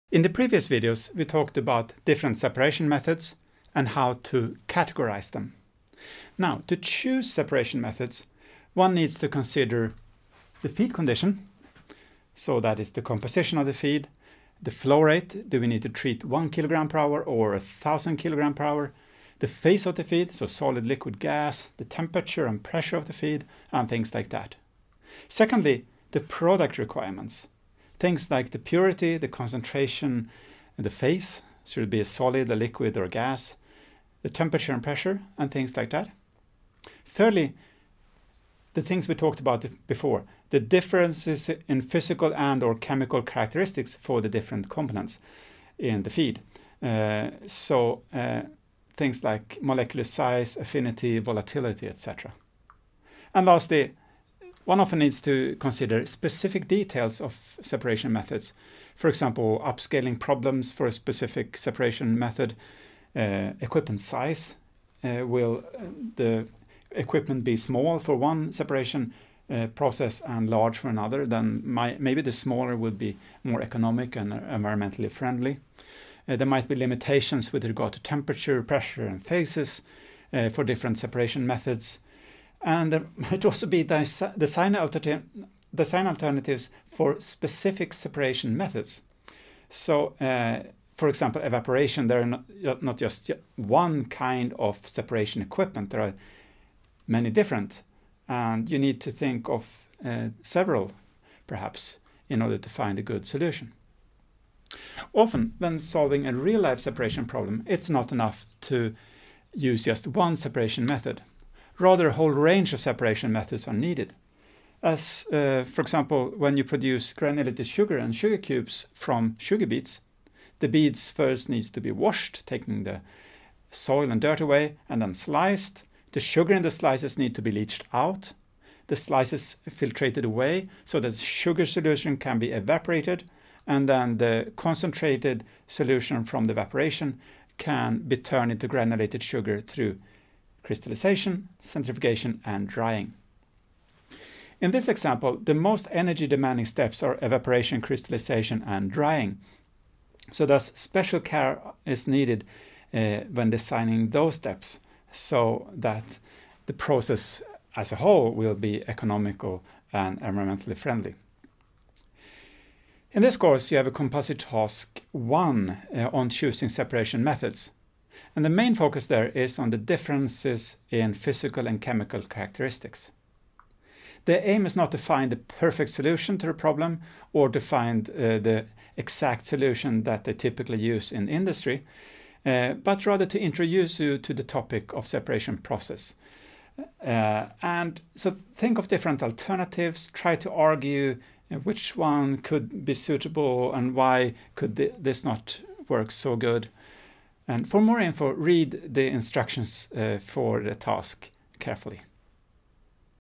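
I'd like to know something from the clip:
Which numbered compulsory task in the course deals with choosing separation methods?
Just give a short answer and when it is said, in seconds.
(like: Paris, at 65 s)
Task 1, at 164 s.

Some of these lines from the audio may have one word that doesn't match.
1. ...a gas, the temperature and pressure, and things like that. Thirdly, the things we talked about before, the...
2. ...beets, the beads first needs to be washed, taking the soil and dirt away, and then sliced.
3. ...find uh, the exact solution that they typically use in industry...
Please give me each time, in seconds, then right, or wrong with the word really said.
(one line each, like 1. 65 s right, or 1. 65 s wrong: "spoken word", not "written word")
1. 33 s right
2. 119 s right
3. 177 s right.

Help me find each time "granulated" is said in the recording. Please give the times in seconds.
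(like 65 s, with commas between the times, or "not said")
117 s, 138 s.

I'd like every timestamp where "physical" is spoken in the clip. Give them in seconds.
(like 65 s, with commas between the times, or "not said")
41 s, 171 s.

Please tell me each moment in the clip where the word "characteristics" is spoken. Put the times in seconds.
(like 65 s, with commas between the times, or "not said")
43 s, 172 s.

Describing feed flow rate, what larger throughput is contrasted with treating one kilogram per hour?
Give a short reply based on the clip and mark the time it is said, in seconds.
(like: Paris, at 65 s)
1000 kilograms per hour, at 17 s.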